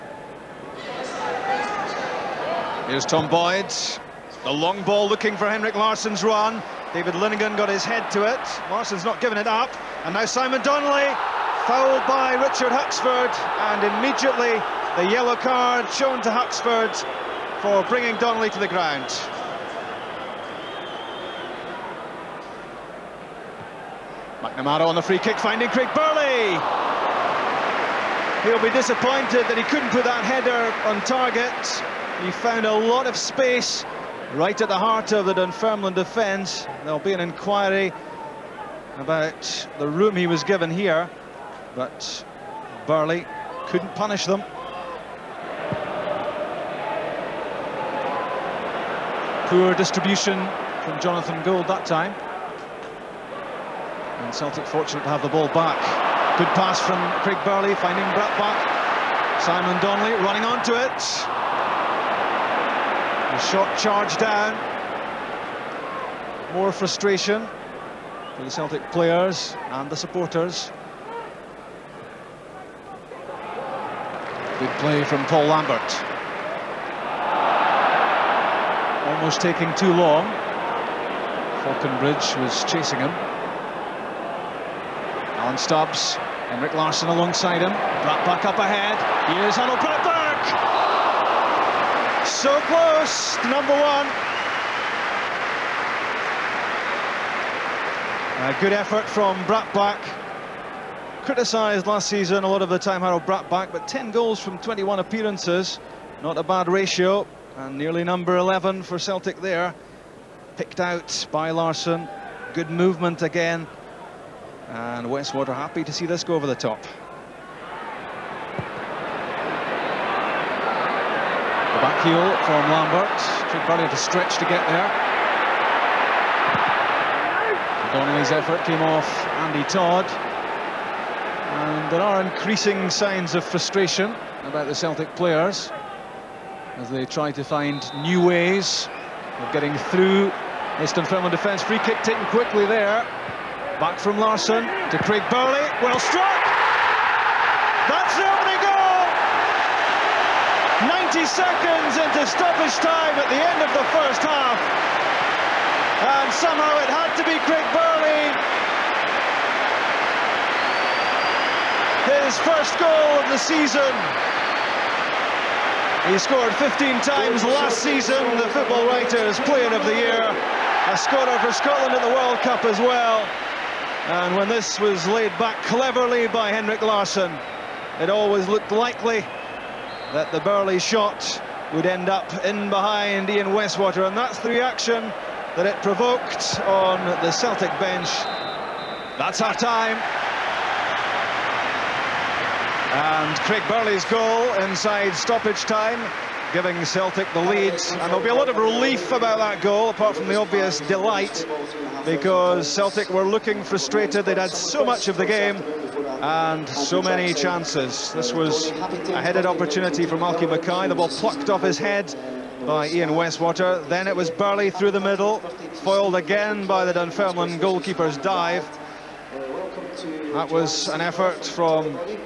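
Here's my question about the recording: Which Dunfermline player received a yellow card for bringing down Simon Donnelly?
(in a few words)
Richard Huxford.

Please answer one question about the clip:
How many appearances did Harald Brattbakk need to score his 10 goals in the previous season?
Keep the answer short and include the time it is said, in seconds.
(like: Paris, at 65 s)
21, at 104 s.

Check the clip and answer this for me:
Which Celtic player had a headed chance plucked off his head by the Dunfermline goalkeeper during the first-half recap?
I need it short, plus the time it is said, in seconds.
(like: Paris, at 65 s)
Malky Mackay, at 210 s.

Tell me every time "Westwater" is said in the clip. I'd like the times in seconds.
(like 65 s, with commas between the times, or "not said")
115 s, 183 s, 213 s.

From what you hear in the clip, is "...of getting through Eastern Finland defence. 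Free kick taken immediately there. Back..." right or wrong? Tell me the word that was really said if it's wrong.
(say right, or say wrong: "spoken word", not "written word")
wrong: "quickly", not "immediately".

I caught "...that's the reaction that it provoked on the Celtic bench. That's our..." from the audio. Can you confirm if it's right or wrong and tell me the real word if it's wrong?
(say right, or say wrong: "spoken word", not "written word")
right.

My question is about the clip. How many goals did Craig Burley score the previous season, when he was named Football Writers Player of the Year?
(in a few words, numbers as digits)
15.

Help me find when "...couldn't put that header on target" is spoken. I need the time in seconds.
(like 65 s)
29 s.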